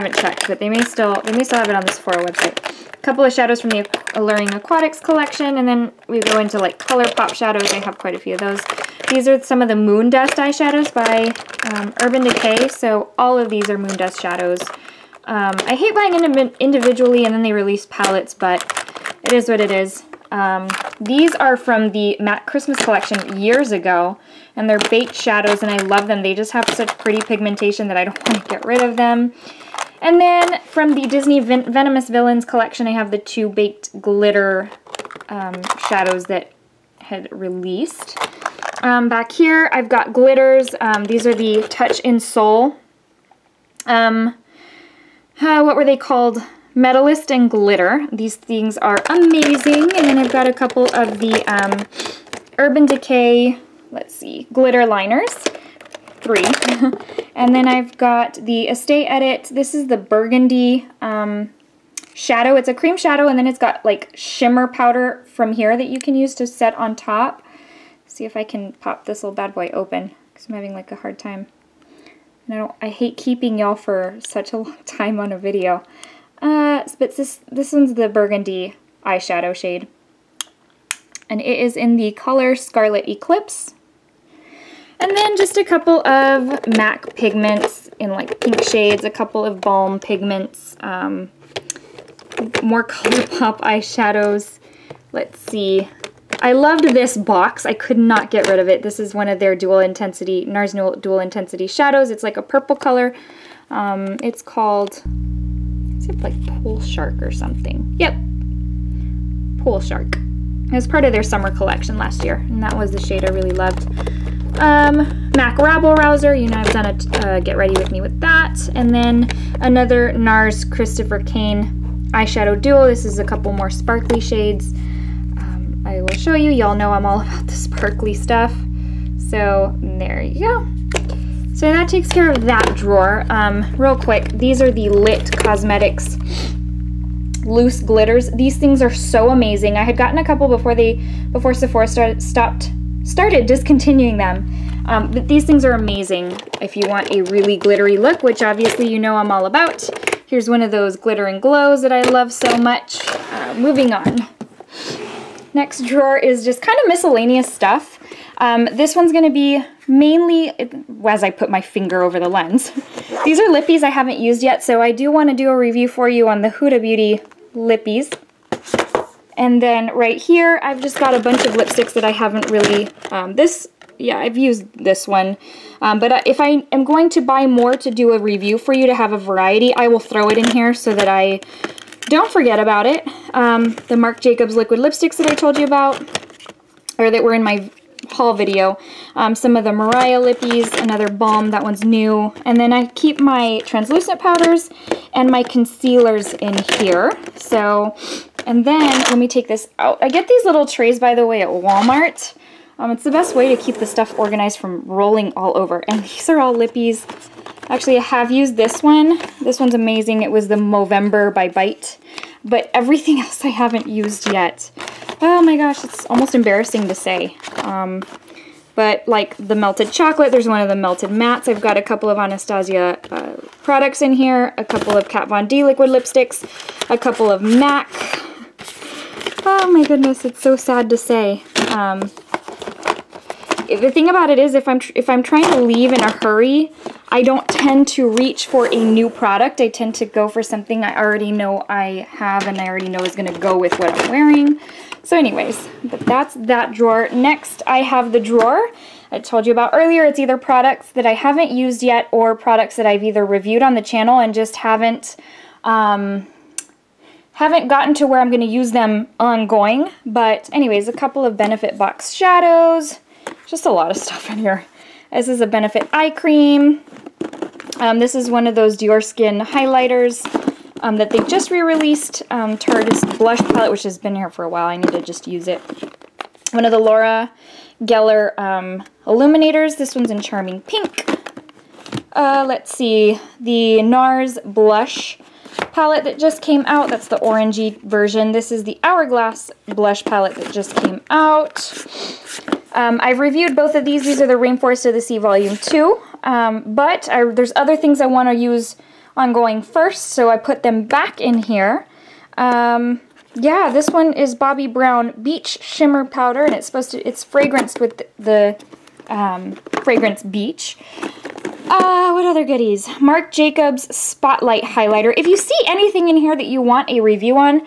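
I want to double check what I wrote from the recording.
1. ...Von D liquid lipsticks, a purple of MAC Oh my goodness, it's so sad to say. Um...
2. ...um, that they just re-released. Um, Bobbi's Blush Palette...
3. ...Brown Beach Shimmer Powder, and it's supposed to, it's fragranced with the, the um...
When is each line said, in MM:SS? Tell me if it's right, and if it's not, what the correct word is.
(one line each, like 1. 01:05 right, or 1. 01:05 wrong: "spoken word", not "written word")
1. 03:45 wrong: "couple", not "purple"
2. 04:30 wrong: "Tarte", not "Bobbi"
3. 05:04 right.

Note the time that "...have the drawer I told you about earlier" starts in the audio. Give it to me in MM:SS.
04:07.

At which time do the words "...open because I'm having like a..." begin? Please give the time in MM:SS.
01:09.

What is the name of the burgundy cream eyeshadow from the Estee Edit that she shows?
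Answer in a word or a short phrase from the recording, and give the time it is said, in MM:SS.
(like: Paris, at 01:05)
Scarlet Eclipse, at 01:22.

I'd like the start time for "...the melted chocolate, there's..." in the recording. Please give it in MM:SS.
03:39.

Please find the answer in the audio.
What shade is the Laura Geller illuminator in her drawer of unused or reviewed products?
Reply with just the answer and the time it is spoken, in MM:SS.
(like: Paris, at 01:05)
Charming Pink, at 04:40.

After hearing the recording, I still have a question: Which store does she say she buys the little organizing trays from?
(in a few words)
Walmart.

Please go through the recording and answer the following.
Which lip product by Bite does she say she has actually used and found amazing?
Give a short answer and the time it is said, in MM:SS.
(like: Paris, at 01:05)
Movember, at 03:30.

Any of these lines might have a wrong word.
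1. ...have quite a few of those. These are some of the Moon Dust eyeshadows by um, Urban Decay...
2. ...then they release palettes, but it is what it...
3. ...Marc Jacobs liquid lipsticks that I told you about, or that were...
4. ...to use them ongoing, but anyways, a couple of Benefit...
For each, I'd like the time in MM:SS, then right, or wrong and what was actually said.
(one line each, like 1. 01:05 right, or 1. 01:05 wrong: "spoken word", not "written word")
1. 00:07 right
2. 00:17 right
3. 03:03 right
4. 04:18 right.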